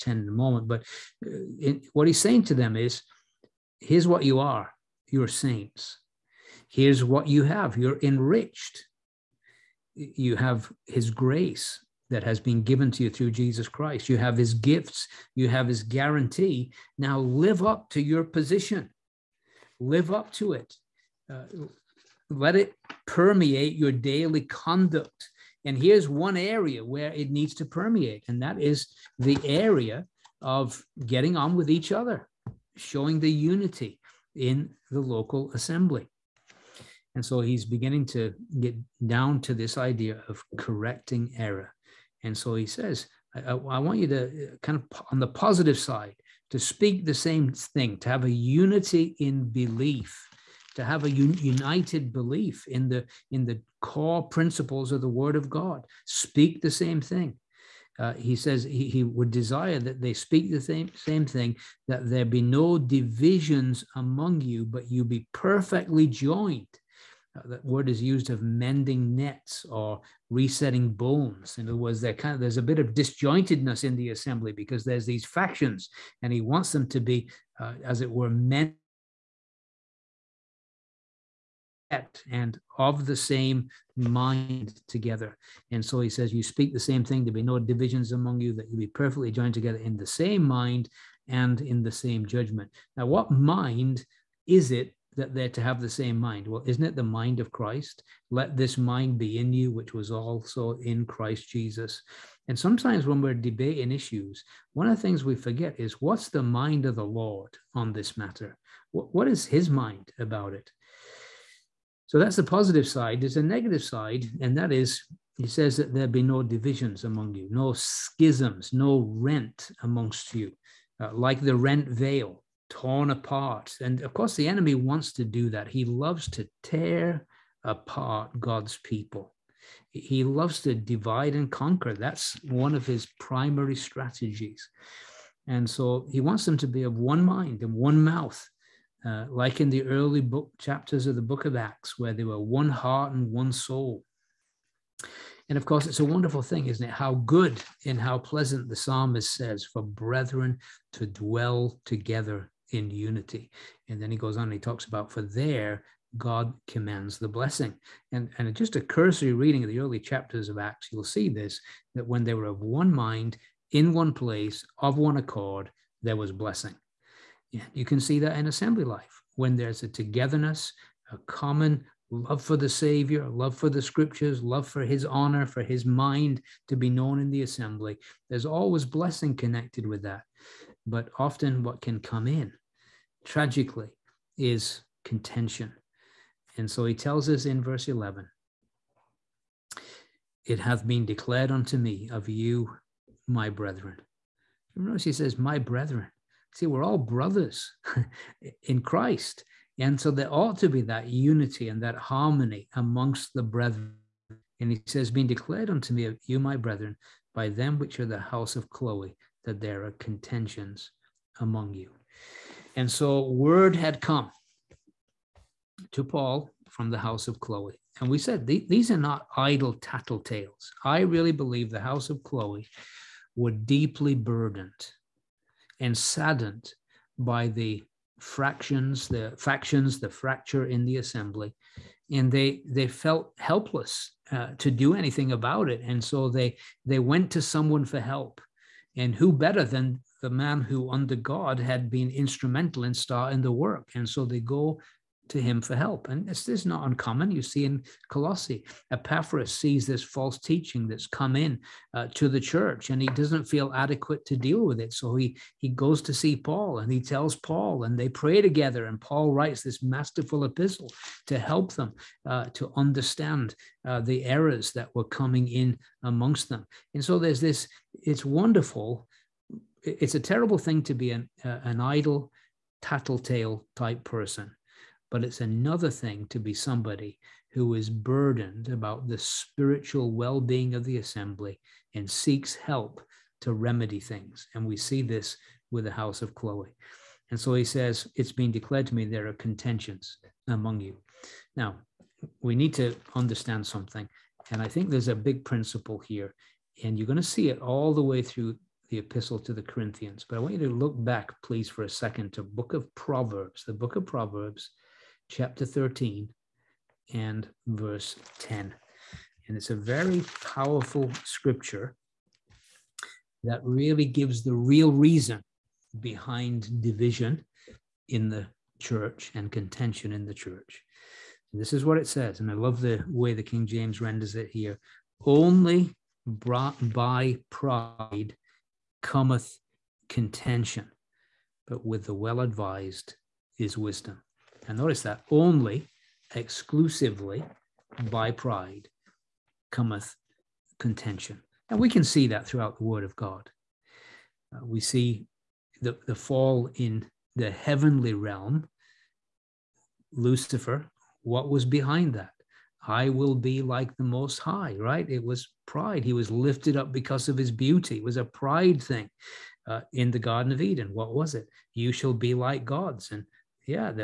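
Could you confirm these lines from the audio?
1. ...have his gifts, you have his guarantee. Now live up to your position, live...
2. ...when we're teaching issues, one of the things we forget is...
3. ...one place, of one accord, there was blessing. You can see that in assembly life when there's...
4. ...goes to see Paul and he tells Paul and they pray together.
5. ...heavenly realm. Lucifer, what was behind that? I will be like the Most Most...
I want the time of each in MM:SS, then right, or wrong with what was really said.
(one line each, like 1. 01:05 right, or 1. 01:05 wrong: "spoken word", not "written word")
1. 00:14 right
2. 01:43 wrong: "debating", not "teaching"
3. 02:43 right
4. 04:15 right
5. 05:47 wrong: "High", not "Most".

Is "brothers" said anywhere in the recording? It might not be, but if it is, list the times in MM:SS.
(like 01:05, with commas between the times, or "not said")
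03:16.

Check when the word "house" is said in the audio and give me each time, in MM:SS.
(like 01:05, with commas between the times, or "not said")
03:28, 03:36, 03:41, 04:45.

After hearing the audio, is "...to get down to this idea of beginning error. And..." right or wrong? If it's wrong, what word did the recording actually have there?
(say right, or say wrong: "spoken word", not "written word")
wrong: "correcting", not "beginning".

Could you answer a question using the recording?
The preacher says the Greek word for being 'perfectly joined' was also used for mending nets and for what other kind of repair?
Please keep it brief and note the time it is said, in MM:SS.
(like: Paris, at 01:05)
Resetting bones, at 01:10.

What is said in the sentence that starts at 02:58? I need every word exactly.
There's always blessing connected with that.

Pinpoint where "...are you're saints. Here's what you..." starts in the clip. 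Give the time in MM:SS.
00:04.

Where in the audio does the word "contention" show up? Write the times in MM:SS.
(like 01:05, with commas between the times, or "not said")
03:05, 03:29, 04:49, 05:19, 05:30, 05:40.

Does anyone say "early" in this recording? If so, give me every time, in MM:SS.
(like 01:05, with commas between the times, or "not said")
02:19, 02:39.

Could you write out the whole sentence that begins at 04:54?
And I think there's a big principle here.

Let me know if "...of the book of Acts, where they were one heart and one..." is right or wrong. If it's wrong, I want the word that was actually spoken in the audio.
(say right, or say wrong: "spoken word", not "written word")
right.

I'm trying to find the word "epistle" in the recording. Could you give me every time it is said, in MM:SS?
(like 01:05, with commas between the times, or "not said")
04:20, 04:58.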